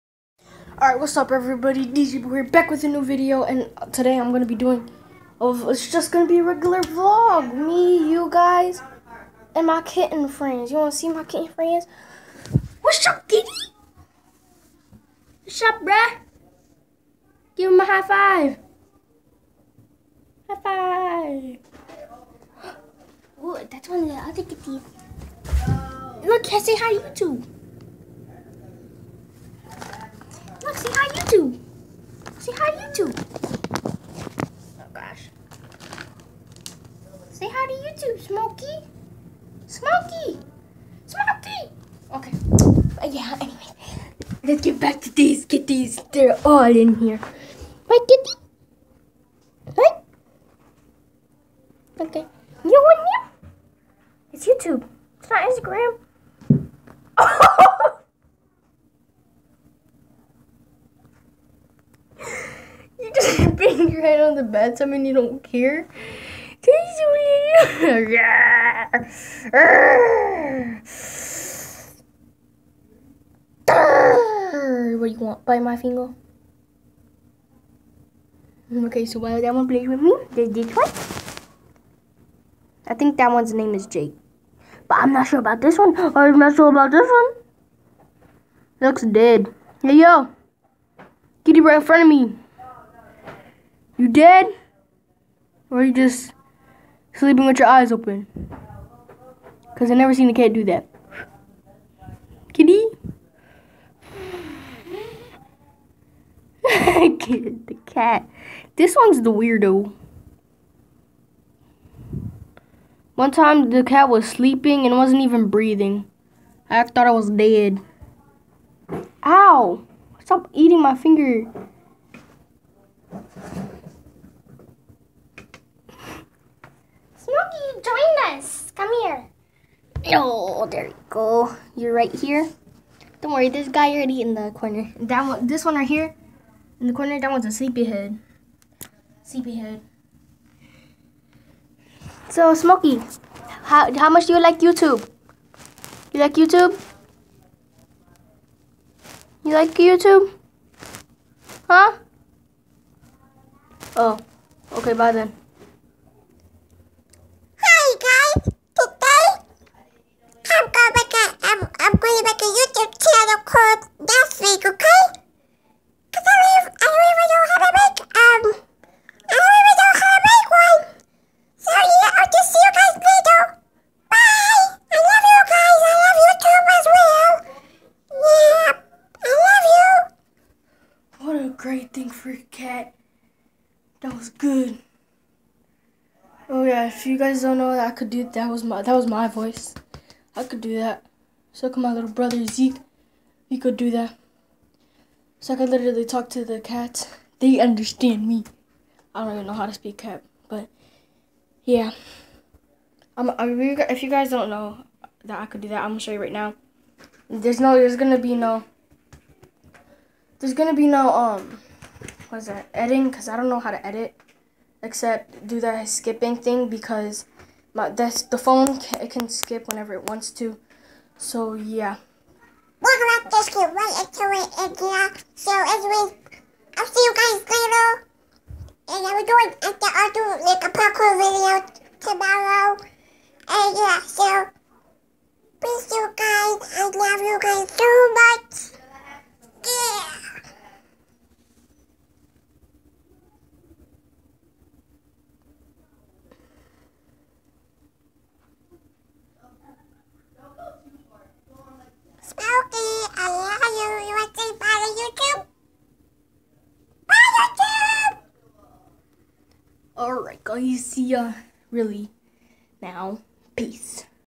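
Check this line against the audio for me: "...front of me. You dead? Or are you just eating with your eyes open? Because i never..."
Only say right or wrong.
wrong.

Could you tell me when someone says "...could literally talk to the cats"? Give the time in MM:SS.
03:15.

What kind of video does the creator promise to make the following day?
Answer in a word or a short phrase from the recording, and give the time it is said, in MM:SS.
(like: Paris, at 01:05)
A parkour video, at 03:50.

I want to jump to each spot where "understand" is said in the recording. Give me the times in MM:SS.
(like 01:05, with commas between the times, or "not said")
03:17.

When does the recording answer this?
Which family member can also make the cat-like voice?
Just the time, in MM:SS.
03:12.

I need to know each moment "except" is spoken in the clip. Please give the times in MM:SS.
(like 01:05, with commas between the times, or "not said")
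03:34.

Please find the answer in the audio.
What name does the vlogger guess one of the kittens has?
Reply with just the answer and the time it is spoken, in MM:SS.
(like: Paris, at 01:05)
Jake, at 01:23.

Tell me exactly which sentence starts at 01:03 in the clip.
your head on the bed, I mean you don't care.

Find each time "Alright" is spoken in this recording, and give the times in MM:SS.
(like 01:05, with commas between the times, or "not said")
00:00, 04:20.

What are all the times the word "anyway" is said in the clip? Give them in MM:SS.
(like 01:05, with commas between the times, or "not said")
00:43, 03:45.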